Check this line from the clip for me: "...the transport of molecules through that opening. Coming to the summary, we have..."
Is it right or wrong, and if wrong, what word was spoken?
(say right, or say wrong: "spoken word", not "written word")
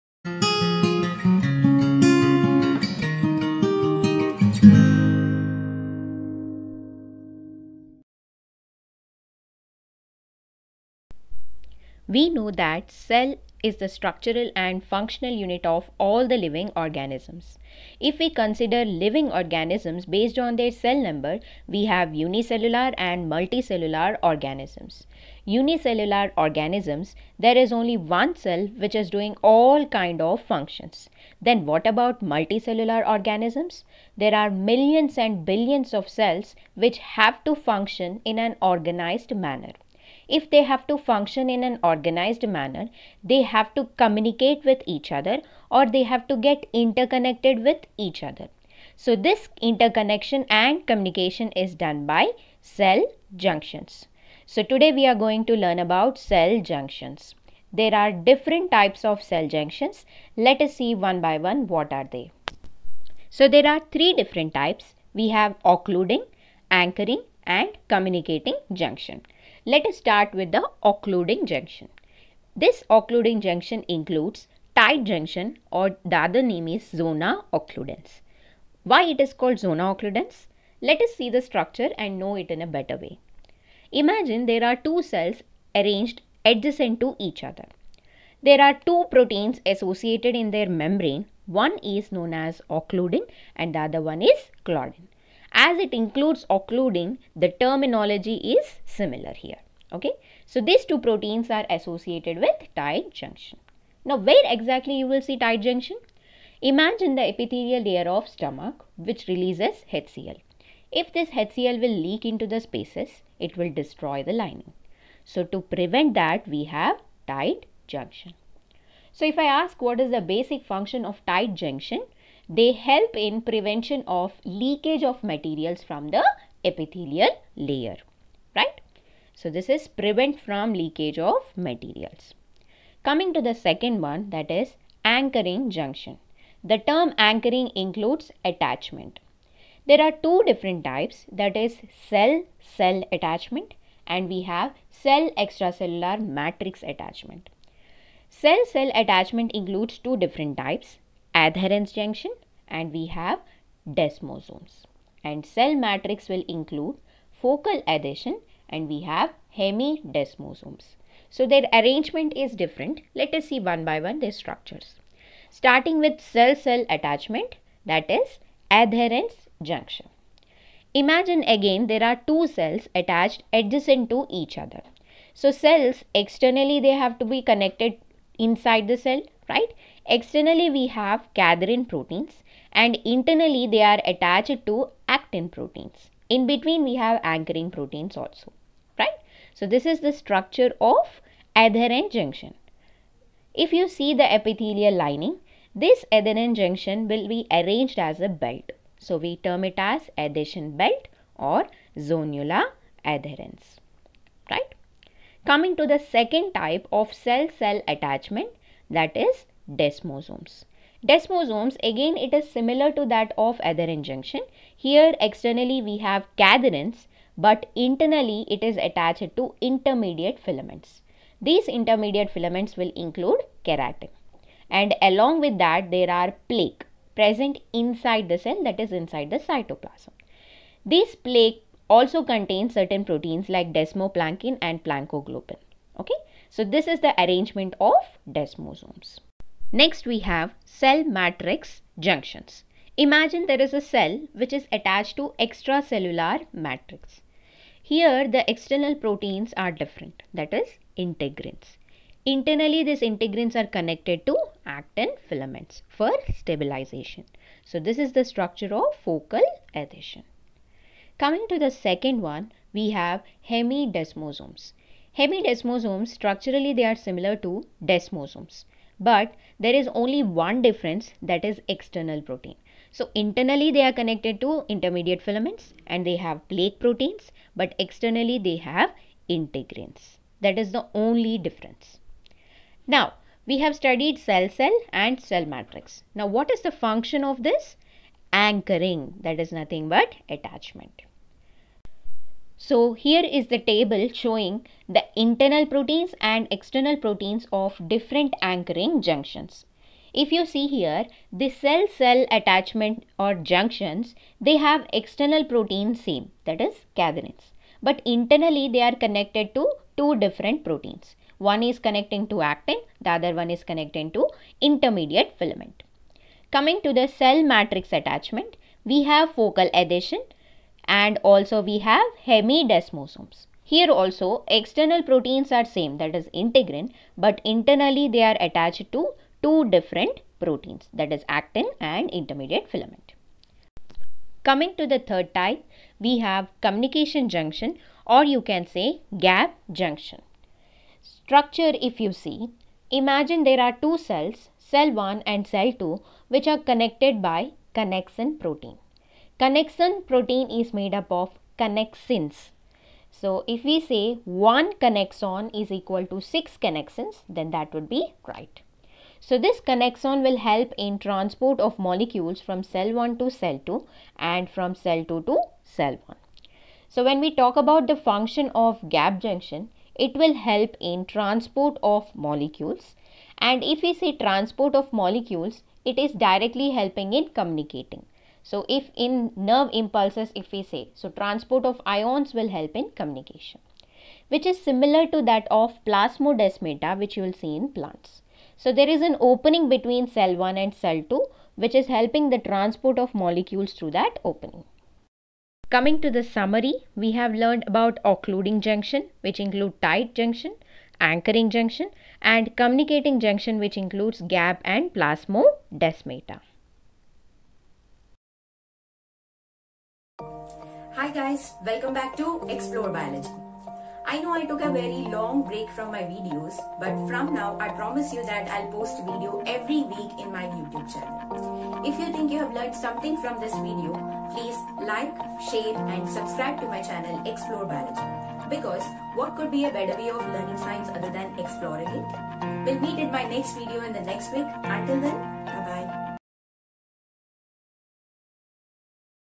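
right.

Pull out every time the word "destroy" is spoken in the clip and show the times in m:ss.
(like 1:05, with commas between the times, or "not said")
1:53.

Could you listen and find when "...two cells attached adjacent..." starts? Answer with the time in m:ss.
2:52.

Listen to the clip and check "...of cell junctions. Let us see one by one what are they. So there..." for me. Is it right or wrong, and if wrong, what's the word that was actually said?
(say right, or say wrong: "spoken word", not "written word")
right.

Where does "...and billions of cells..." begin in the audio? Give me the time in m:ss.
0:35.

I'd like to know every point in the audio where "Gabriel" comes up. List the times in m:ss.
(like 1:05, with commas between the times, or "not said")
not said.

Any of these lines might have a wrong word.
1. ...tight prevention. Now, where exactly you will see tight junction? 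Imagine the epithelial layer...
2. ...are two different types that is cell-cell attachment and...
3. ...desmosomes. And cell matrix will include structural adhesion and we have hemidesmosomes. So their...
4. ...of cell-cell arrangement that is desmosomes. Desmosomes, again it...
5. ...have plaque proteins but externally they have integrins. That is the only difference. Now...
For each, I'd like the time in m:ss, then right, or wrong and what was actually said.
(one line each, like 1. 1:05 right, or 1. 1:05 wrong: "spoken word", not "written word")
1. 1:42 wrong: "junction", not "prevention"
2. 2:20 right
3. 2:33 wrong: "focal", not "structural"
4. 3:26 wrong: "attachment", not "arrangement"
5. 4:36 right.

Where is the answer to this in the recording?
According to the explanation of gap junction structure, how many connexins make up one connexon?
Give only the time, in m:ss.
5:56.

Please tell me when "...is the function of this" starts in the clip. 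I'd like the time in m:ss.
4:46.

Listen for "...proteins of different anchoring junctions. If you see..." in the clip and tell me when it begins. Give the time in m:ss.
4:56.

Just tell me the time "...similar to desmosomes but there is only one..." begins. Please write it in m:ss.
4:26.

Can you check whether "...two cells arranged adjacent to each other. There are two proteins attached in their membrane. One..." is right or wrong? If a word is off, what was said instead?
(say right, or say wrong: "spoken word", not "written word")
wrong: "associated", not "attached".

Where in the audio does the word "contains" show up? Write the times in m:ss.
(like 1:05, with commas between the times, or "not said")
3:52.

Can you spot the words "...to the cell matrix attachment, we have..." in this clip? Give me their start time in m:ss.
5:16.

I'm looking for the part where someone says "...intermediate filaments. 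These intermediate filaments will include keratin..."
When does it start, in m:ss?
3:39.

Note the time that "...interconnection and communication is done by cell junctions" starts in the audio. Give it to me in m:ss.
0:49.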